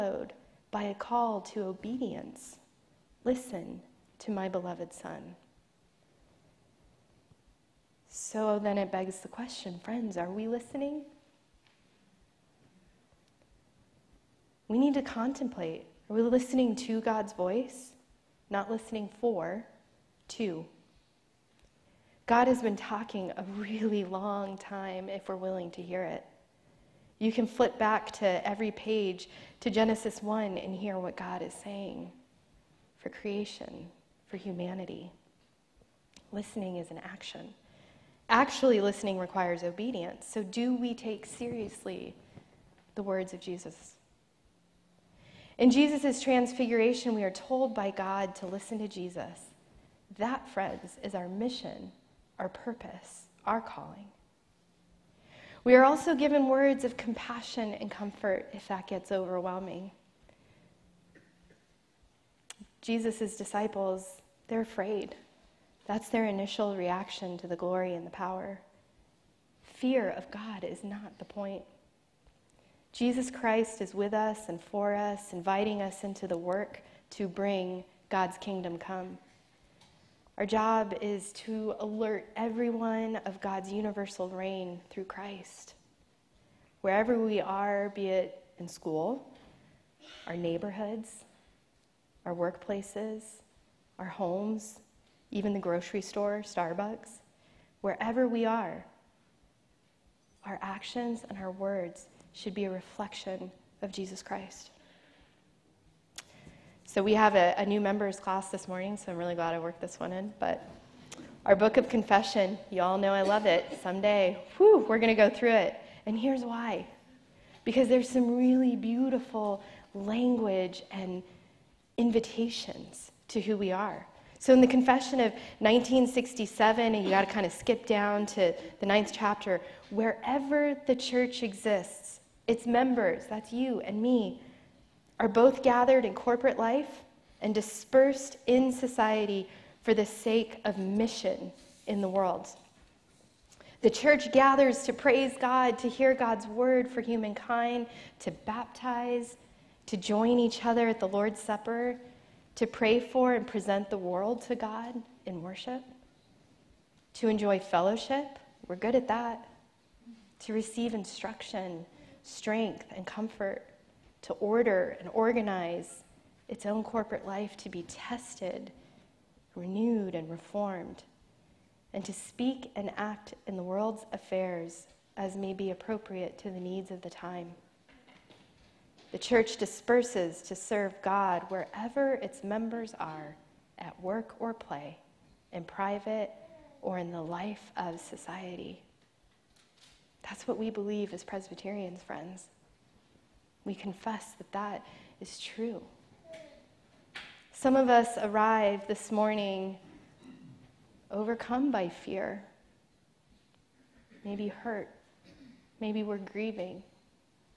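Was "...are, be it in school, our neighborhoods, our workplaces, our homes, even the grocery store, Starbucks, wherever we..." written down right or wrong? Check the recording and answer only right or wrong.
right.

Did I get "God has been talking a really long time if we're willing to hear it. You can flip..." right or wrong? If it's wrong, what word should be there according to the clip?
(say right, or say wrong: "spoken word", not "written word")
right.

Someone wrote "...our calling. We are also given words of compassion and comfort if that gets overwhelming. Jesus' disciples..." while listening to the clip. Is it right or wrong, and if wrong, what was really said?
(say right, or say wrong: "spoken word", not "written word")
right.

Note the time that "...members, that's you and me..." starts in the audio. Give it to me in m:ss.
2:12.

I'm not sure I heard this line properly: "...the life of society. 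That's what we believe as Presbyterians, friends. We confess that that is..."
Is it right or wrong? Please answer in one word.
right.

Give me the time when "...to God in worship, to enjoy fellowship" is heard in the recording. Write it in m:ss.
2:34.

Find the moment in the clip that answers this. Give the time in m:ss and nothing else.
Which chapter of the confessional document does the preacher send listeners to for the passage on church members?
2:08.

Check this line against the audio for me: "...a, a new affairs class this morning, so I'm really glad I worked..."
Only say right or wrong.
wrong.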